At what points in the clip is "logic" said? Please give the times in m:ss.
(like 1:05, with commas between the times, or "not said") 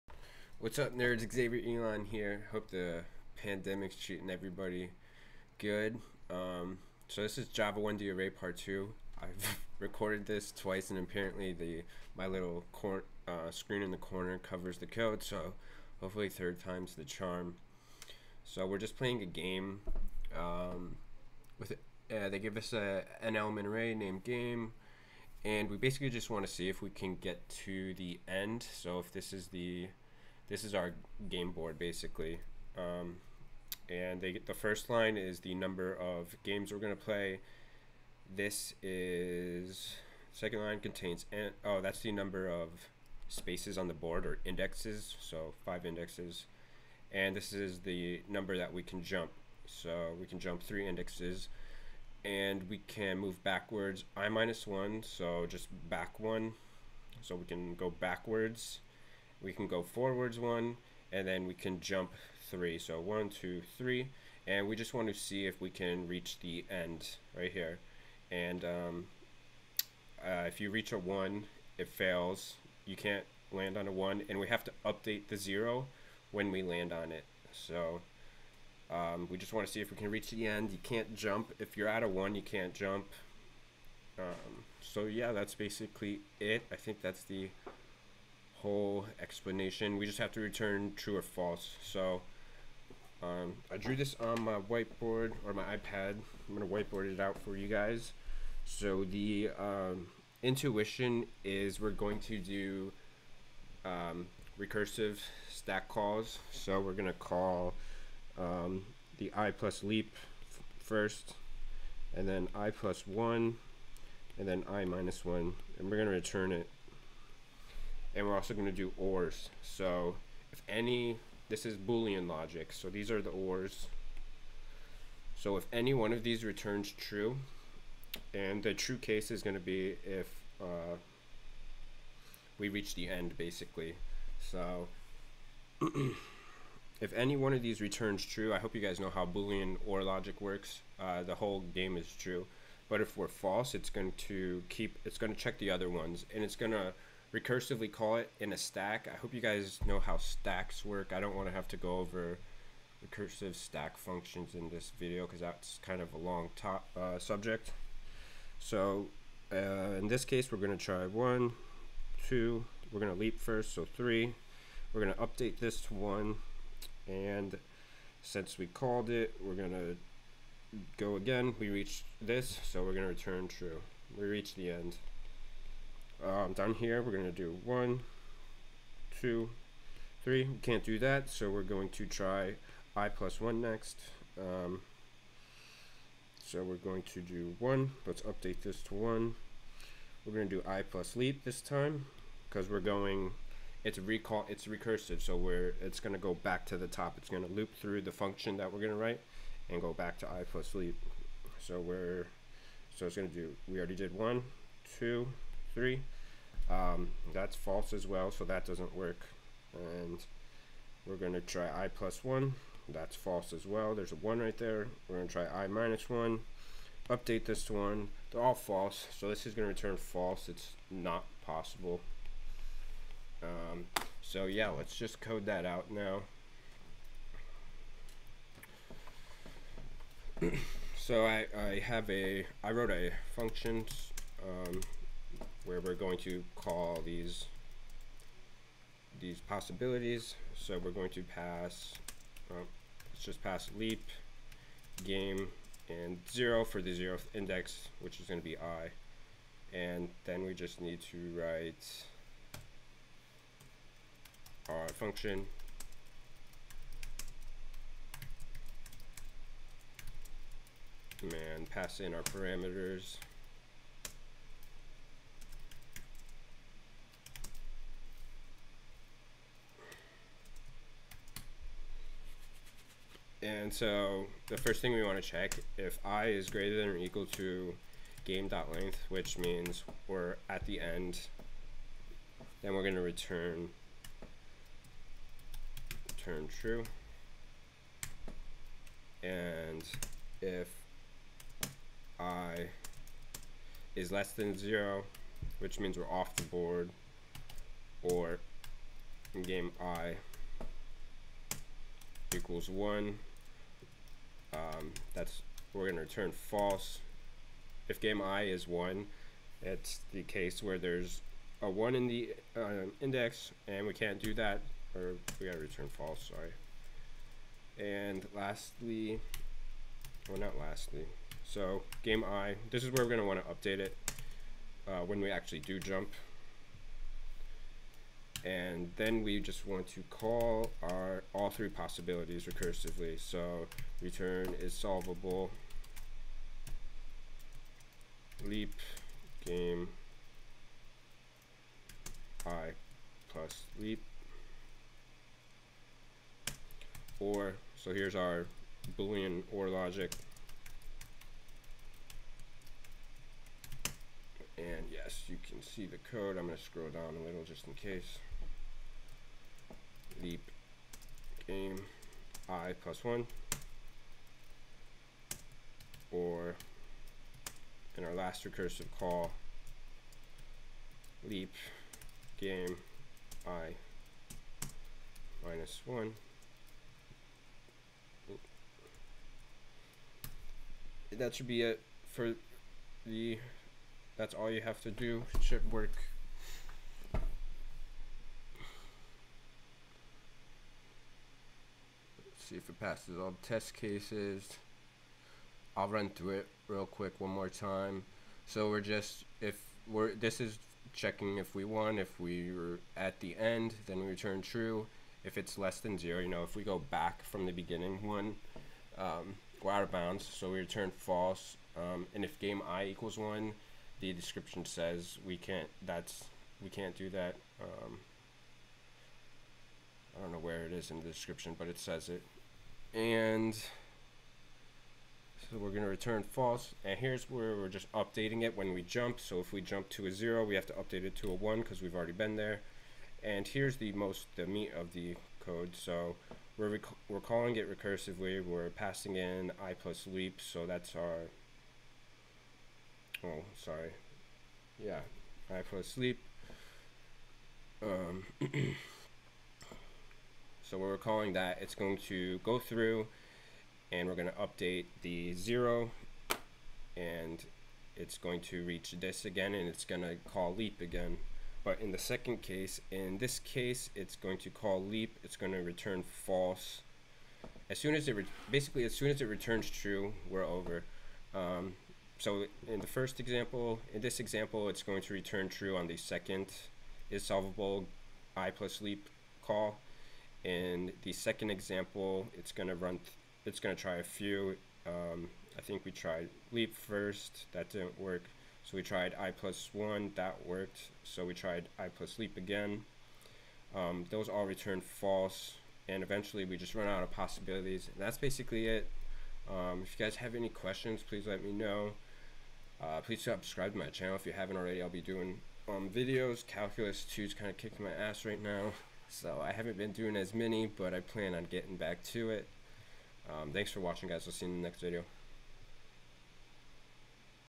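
2:02, 2:20, 5:49.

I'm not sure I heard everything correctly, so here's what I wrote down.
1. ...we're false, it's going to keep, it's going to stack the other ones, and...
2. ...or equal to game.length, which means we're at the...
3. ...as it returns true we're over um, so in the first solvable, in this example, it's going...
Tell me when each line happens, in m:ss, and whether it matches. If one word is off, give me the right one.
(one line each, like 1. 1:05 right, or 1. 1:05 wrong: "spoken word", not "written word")
1. 2:23 wrong: "check", not "stack"
2. 4:36 right
3. 7:49 wrong: "example", not "solvable".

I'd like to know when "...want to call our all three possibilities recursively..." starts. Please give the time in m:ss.
5:29.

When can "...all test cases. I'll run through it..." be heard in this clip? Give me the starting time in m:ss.
6:33.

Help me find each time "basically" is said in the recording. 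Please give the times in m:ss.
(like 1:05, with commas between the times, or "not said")
0:25, 0:31, 1:25, 2:13, 7:48, 8:18.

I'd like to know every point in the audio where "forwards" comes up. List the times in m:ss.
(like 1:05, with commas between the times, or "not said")
0:59.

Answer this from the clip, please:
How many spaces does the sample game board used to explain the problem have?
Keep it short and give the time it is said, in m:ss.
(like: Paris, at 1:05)
5, at 0:45.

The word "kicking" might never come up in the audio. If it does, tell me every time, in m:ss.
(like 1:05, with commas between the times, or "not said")
8:27.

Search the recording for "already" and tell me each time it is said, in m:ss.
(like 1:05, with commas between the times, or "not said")
3:23, 7:11, 8:24.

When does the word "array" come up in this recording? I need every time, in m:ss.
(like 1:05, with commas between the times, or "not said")
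0:08, 0:23.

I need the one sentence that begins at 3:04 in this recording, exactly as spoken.
Um, so we're going to do 1.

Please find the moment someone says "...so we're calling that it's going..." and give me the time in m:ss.
7:30.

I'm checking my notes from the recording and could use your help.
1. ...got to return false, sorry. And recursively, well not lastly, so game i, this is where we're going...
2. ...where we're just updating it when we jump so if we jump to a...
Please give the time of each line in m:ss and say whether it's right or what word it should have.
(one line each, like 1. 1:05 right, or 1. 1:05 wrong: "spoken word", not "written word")
1. 5:15 wrong: "lastly", not "recursively"
2. 7:07 right.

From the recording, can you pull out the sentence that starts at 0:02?
Hope the pandemic's treating everybody good.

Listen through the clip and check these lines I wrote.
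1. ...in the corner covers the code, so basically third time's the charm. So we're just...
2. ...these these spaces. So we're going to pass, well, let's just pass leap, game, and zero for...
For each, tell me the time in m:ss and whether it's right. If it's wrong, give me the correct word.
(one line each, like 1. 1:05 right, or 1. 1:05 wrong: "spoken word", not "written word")
1. 0:13 wrong: "hopefully", not "basically"
2. 3:57 wrong: "possibilities", not "spaces".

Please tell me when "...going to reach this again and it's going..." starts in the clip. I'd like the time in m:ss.
7:38.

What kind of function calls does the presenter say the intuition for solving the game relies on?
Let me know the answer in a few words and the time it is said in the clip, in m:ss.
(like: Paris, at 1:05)
recursive stack calls, at 1:44.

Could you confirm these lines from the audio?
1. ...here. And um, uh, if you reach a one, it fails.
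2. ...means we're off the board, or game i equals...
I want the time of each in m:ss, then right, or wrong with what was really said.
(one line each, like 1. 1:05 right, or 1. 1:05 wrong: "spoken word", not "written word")
1. 1:07 right
2. 4:55 right.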